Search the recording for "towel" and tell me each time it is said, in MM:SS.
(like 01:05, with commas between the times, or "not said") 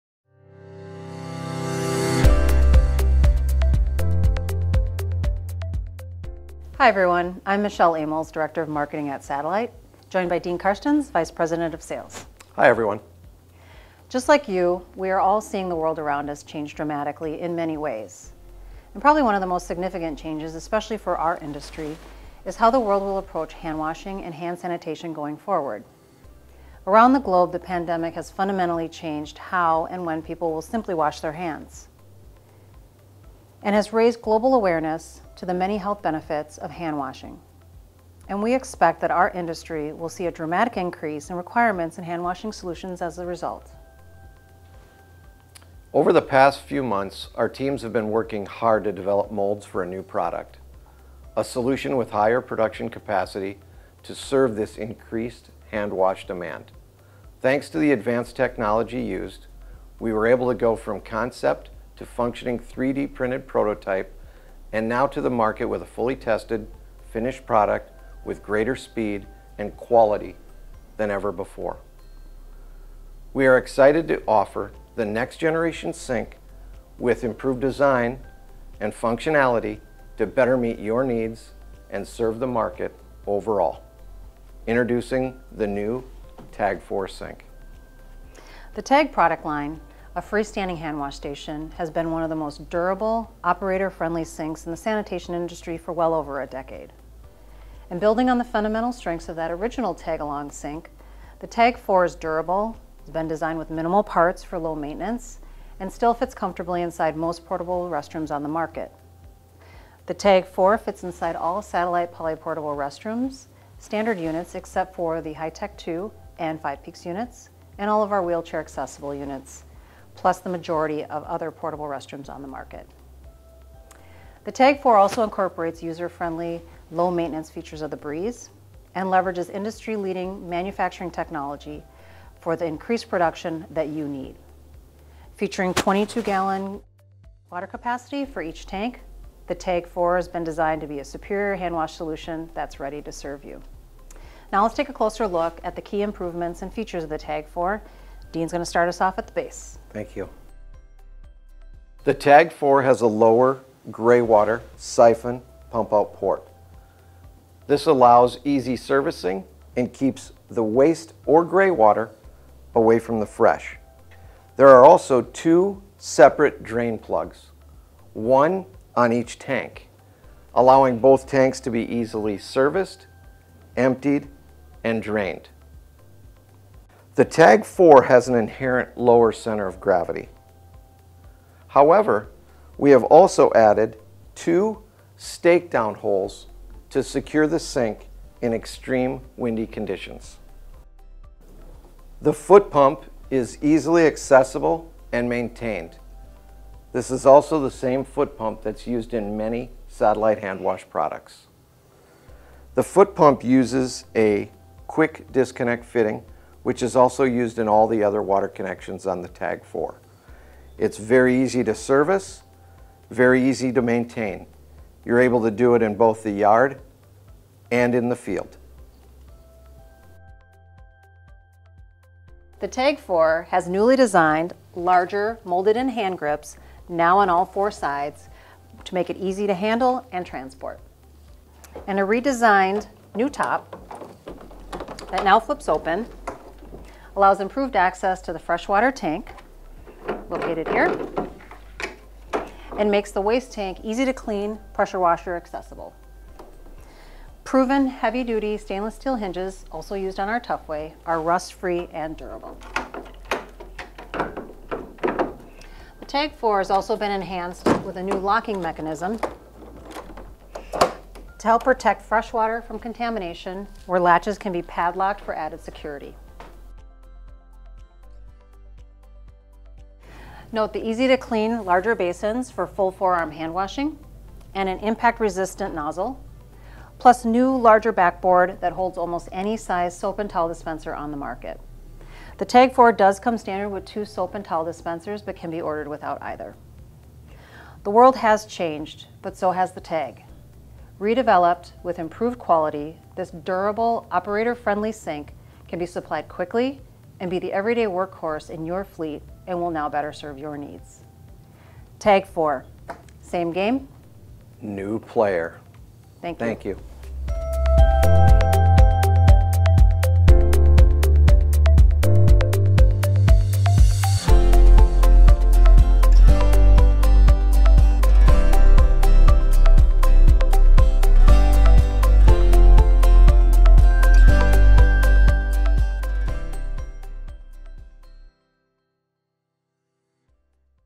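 04:40, 04:44.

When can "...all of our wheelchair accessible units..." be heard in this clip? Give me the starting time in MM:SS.
01:57.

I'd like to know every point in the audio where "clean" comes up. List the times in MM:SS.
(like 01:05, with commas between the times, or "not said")
04:04, 04:31.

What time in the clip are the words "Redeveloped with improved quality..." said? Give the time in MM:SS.
04:50.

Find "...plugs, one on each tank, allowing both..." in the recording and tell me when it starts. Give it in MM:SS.
02:46.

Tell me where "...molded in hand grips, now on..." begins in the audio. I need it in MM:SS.
03:45.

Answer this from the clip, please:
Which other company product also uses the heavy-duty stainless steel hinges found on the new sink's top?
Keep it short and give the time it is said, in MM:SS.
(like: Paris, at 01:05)
Tufway, at 04:10.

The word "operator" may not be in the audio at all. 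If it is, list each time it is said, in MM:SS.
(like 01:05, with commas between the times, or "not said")
01:33, 04:54.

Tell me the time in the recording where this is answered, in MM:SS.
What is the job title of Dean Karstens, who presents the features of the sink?
00:11.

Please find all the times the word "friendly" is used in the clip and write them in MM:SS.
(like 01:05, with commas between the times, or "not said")
01:33, 02:05, 04:54.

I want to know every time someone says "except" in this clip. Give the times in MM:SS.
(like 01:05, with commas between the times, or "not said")
01:54.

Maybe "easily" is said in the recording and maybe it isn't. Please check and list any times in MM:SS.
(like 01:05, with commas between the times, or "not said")
02:51, 03:13.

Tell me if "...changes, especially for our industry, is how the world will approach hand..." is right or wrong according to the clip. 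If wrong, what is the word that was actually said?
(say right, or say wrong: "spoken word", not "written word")
right.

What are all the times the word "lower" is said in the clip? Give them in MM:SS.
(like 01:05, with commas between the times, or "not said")
02:33, 02:58.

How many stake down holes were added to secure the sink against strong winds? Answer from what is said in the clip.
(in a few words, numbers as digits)
2.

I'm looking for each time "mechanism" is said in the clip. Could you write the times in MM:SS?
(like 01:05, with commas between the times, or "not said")
04:18.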